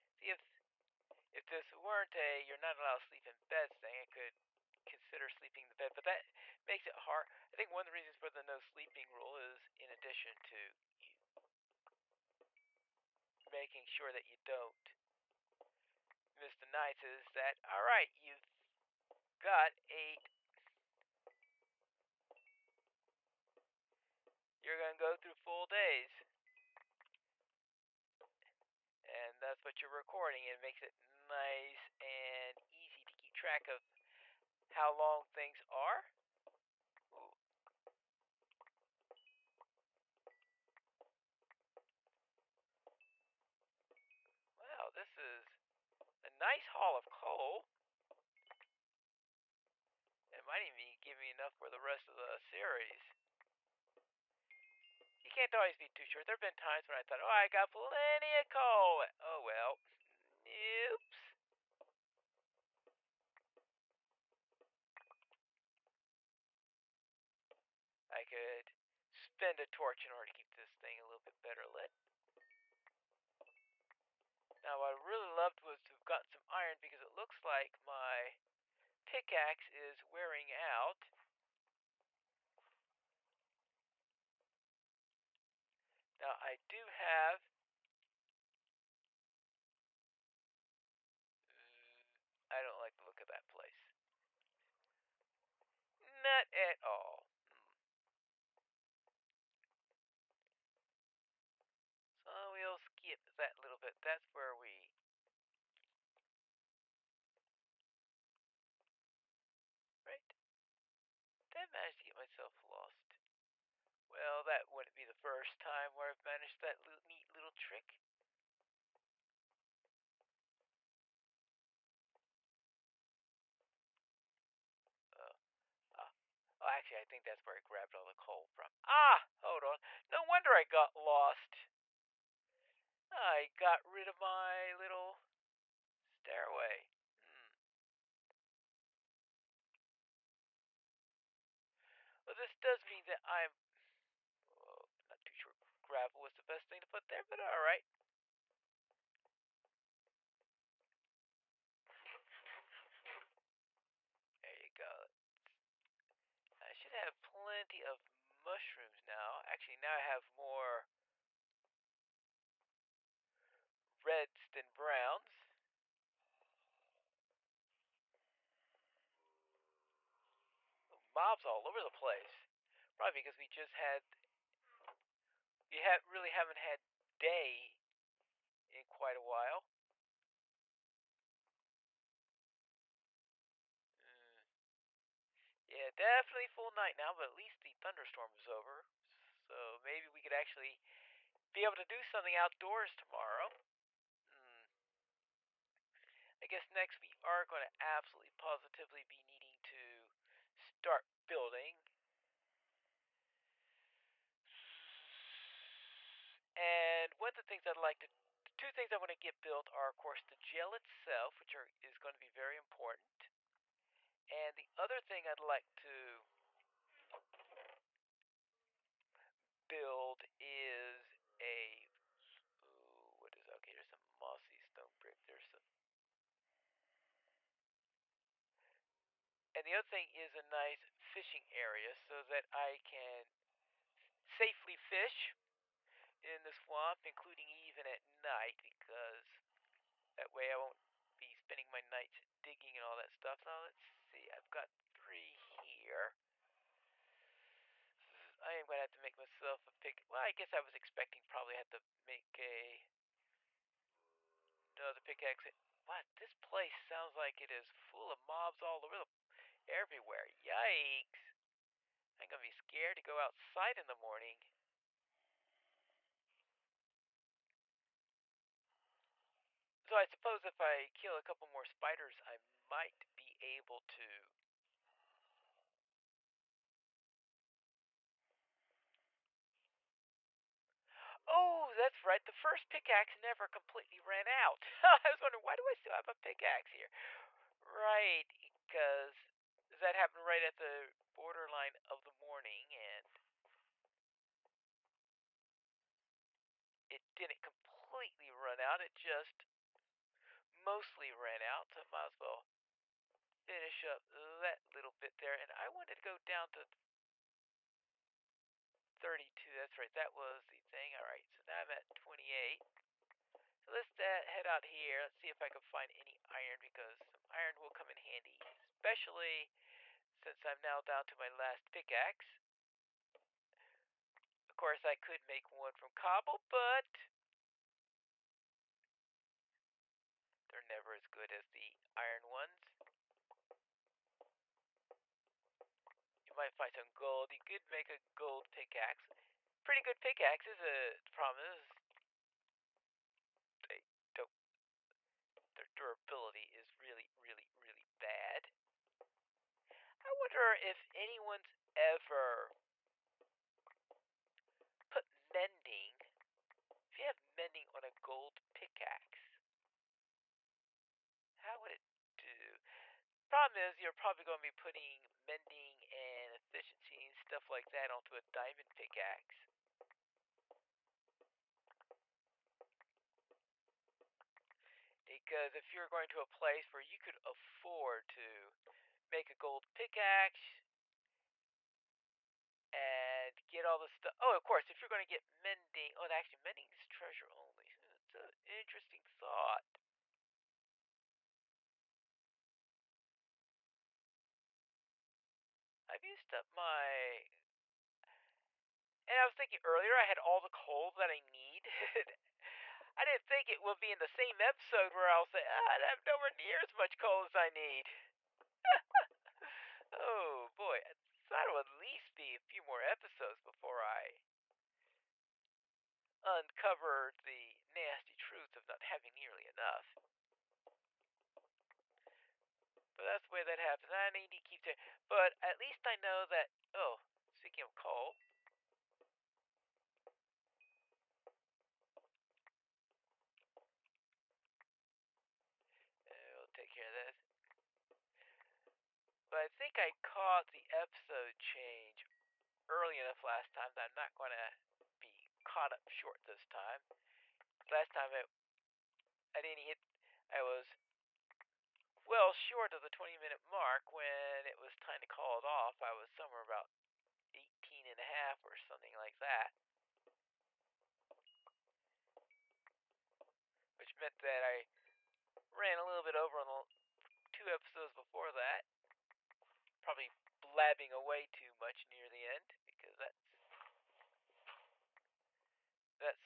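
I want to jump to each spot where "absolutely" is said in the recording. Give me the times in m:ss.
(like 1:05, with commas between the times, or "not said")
3:17.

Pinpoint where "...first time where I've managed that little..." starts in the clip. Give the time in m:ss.
1:55.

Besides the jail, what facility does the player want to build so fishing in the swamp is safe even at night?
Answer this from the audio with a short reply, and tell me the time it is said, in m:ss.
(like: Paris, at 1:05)
Fishing area, at 3:50.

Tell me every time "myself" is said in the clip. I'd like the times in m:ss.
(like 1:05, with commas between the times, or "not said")
1:52, 4:09.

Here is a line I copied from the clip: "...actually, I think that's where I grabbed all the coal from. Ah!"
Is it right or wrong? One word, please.
right.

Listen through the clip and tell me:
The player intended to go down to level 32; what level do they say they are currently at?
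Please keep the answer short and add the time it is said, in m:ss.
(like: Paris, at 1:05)
28, at 5:11.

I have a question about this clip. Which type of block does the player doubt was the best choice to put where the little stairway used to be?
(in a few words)
Gravel.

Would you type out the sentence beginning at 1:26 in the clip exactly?
Now I do have mm, I don't like the look of that place.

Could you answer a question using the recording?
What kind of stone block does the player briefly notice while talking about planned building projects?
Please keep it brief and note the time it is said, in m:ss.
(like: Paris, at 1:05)
Mossy stone brick, at 3:44.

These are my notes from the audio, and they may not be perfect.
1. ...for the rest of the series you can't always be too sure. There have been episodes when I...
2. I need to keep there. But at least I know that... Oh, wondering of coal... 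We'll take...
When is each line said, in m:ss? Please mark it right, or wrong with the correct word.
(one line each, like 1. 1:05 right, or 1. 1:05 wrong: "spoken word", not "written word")
1. 0:51 wrong: "times", not "episodes"
2. 7:03 wrong: "speaking", not "wondering".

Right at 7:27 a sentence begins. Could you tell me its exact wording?
Last time it, I didn't hit...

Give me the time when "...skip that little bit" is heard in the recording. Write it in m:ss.
1:42.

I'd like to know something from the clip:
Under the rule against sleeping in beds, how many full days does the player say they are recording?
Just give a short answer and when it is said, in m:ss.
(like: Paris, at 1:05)
8, at 0:19.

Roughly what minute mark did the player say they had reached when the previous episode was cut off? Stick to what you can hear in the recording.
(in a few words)
18 and a half.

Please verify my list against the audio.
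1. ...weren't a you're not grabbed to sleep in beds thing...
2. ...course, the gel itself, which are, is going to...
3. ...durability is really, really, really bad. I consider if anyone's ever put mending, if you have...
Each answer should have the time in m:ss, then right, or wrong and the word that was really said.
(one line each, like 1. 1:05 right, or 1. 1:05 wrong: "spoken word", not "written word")
1. 0:01 wrong: "allowed", not "grabbed"
2. 3:29 right
3. 5:45 wrong: "wonder", not "consider".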